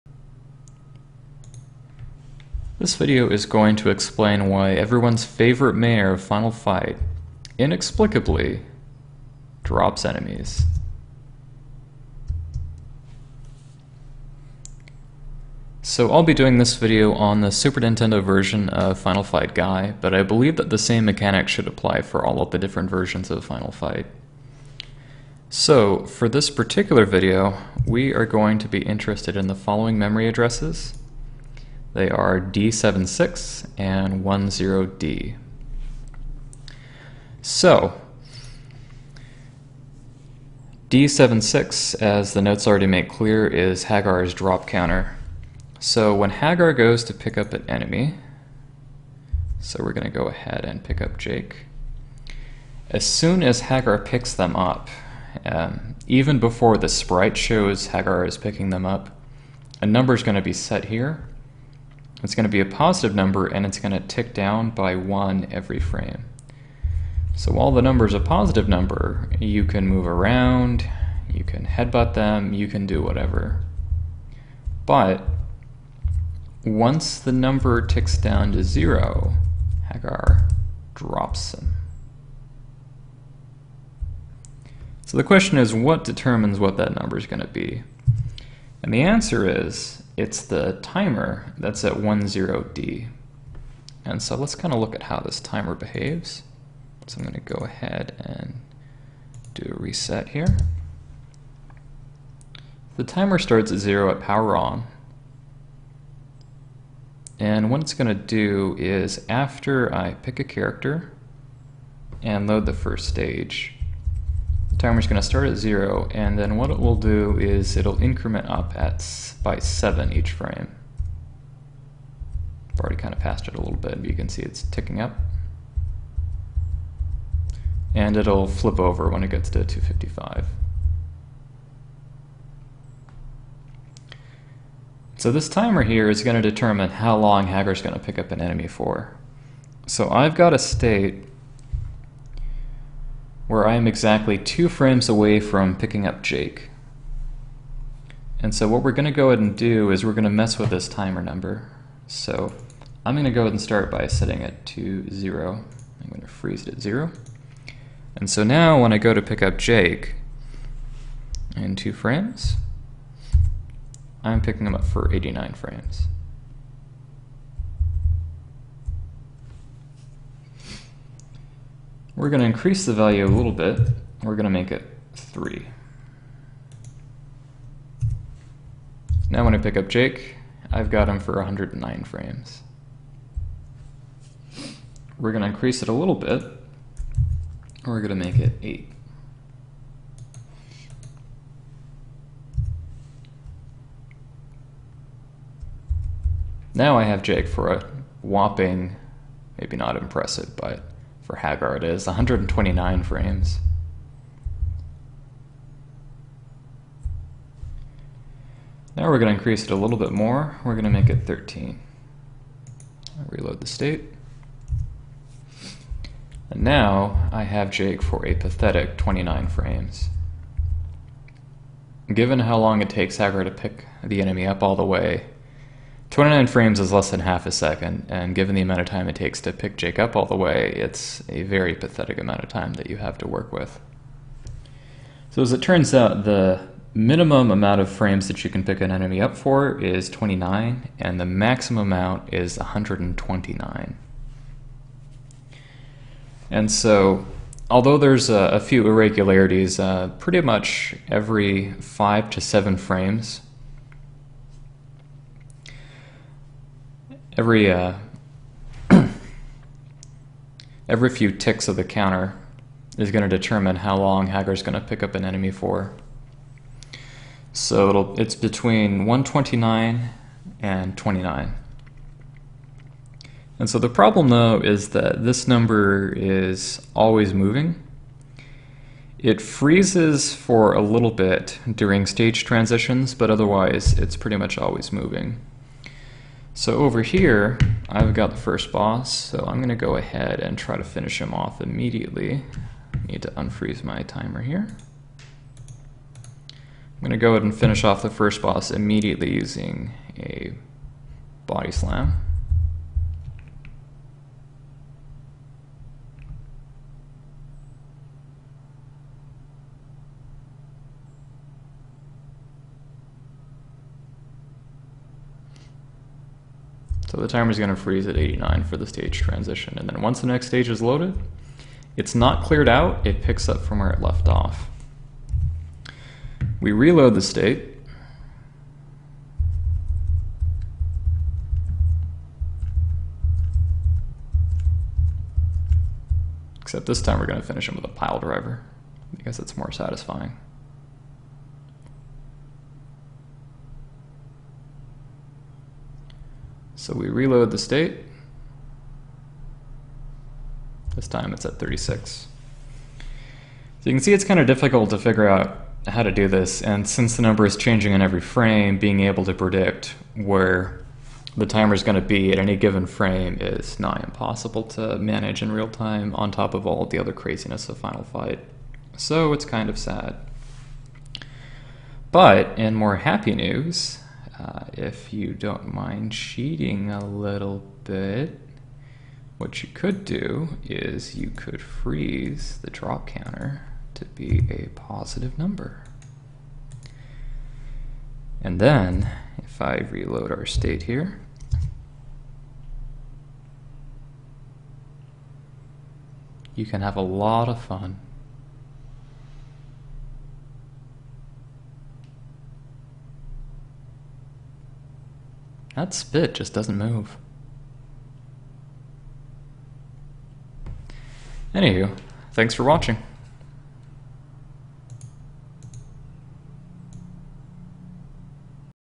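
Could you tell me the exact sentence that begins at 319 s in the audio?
And then once the next stage is loaded, it's not cleared out, it picks up from where it left off.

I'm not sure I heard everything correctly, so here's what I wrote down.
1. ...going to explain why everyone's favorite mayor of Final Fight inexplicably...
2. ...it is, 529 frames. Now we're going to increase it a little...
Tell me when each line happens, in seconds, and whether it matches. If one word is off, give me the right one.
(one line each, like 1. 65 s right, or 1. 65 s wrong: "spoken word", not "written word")
1. 3 s right
2. 201 s wrong: "129", not "529".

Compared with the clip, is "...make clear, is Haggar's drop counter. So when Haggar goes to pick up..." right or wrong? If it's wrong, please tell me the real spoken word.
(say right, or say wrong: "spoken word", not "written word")
right.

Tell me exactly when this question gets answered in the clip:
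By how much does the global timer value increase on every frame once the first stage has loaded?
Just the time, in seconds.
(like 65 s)
119 s.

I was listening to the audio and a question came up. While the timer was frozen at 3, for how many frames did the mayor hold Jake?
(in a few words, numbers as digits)
109.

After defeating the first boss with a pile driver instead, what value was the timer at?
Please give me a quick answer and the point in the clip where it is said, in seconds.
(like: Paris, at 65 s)
36, at 351 s.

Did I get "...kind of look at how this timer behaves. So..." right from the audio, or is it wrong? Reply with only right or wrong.
right.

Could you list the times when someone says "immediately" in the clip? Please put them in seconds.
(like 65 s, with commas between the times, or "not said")
291 s, 298 s.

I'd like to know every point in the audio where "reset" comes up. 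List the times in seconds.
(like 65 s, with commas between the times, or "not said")
99 s.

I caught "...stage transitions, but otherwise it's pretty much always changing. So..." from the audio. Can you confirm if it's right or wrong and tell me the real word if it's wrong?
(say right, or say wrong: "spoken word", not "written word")
wrong: "moving", not "changing".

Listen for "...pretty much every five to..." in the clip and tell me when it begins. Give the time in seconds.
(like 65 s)
250 s.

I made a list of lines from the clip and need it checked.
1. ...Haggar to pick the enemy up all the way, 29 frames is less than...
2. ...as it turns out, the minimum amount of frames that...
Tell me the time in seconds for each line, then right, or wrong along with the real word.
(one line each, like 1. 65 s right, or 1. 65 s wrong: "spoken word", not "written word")
1. 223 s right
2. 235 s right.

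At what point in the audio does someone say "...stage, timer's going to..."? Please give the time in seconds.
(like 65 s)
113 s.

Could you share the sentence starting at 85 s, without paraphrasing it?
So the question is, what determines what that number is going to be?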